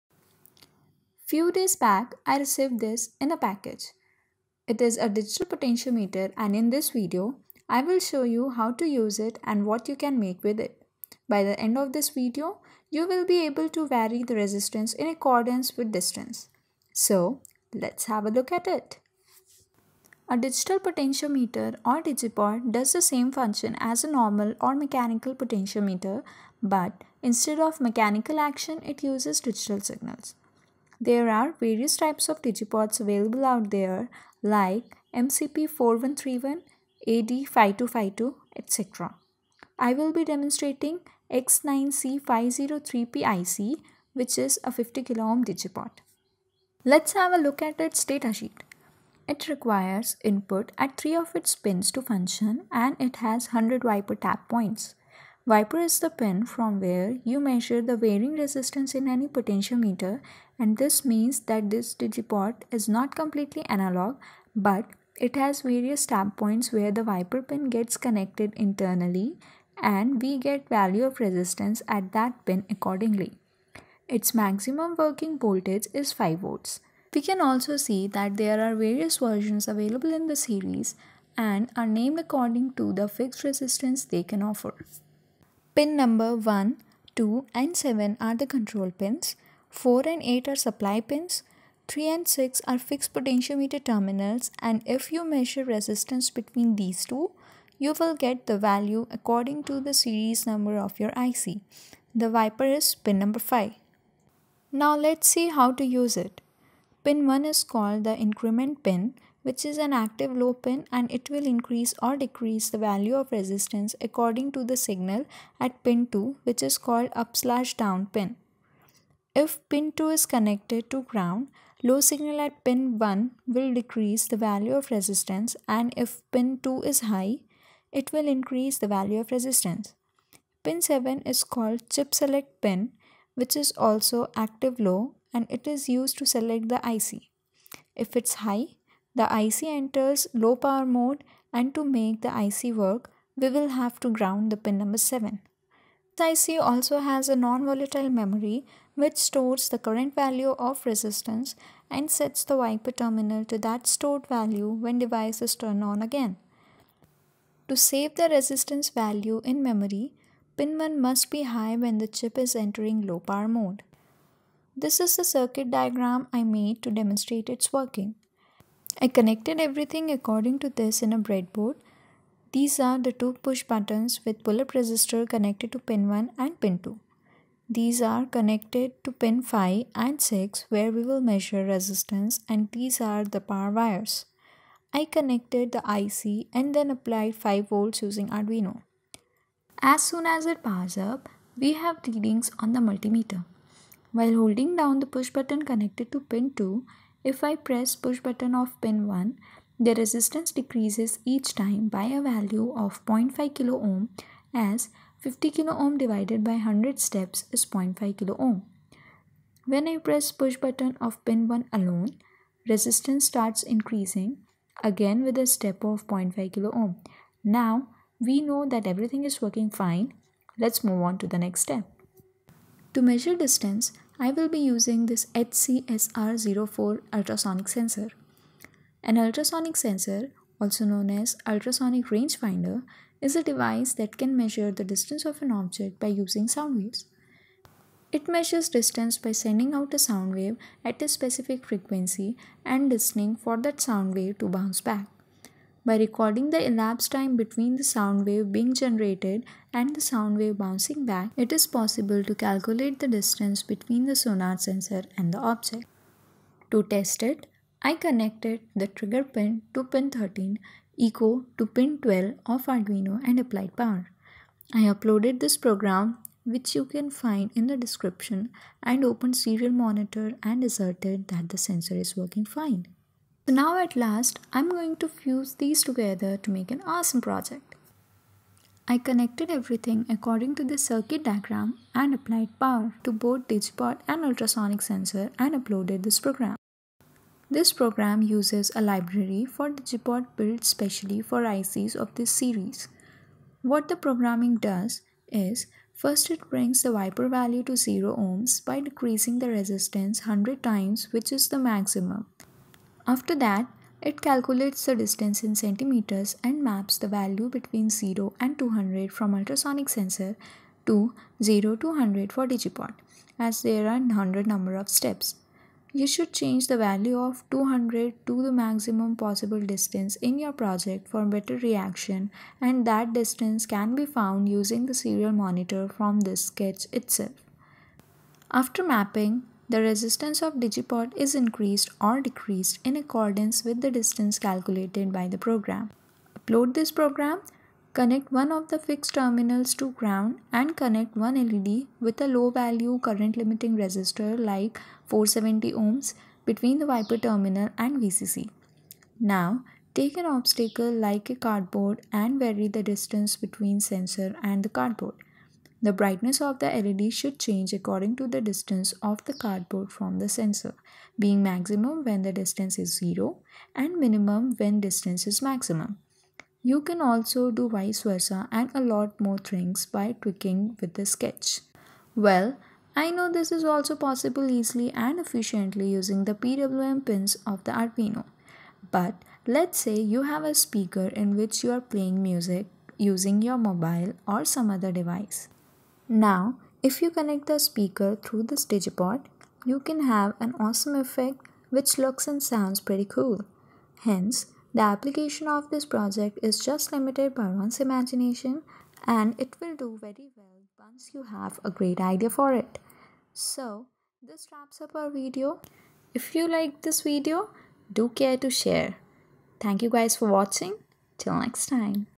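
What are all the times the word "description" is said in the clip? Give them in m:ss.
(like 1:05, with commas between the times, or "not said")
4:27.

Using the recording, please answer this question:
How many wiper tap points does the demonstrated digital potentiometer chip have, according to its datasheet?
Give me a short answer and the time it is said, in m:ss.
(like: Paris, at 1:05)
100, at 0:53.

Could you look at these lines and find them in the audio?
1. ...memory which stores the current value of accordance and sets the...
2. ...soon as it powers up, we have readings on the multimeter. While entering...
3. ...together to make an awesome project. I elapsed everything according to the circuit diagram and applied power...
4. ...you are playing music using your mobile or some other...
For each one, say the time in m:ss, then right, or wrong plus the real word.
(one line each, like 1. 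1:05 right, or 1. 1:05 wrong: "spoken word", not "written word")
1. 2:28 wrong: "resistance", not "accordance"
2. 3:10 wrong: "holding", not "entering"
3. 4:35 wrong: "connected", not "elapsed"
4. 6:21 right.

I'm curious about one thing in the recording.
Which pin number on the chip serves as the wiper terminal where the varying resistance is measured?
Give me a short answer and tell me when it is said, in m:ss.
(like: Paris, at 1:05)
5, at 1:42.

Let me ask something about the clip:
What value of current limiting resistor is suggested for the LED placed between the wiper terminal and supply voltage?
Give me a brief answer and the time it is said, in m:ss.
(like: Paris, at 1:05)
470 ohms, at 5:45.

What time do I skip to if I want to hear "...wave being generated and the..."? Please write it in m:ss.
4:08.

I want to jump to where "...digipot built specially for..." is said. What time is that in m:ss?
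4:49.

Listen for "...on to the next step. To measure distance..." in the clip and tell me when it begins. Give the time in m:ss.
3:41.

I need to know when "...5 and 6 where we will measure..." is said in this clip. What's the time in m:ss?
2:59.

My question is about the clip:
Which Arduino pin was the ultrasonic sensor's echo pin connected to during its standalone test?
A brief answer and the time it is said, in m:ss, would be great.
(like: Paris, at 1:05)
12, at 4:21.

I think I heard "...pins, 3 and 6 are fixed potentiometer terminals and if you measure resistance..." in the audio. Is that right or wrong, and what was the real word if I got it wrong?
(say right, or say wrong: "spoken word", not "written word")
right.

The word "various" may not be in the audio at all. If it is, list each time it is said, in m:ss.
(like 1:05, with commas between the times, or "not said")
0:31, 1:05, 1:18.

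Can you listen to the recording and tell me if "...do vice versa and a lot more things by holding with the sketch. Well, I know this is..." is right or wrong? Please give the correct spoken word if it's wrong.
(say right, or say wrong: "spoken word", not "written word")
wrong: "tweaking", not "holding".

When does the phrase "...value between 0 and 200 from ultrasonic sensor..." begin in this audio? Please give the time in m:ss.
5:07.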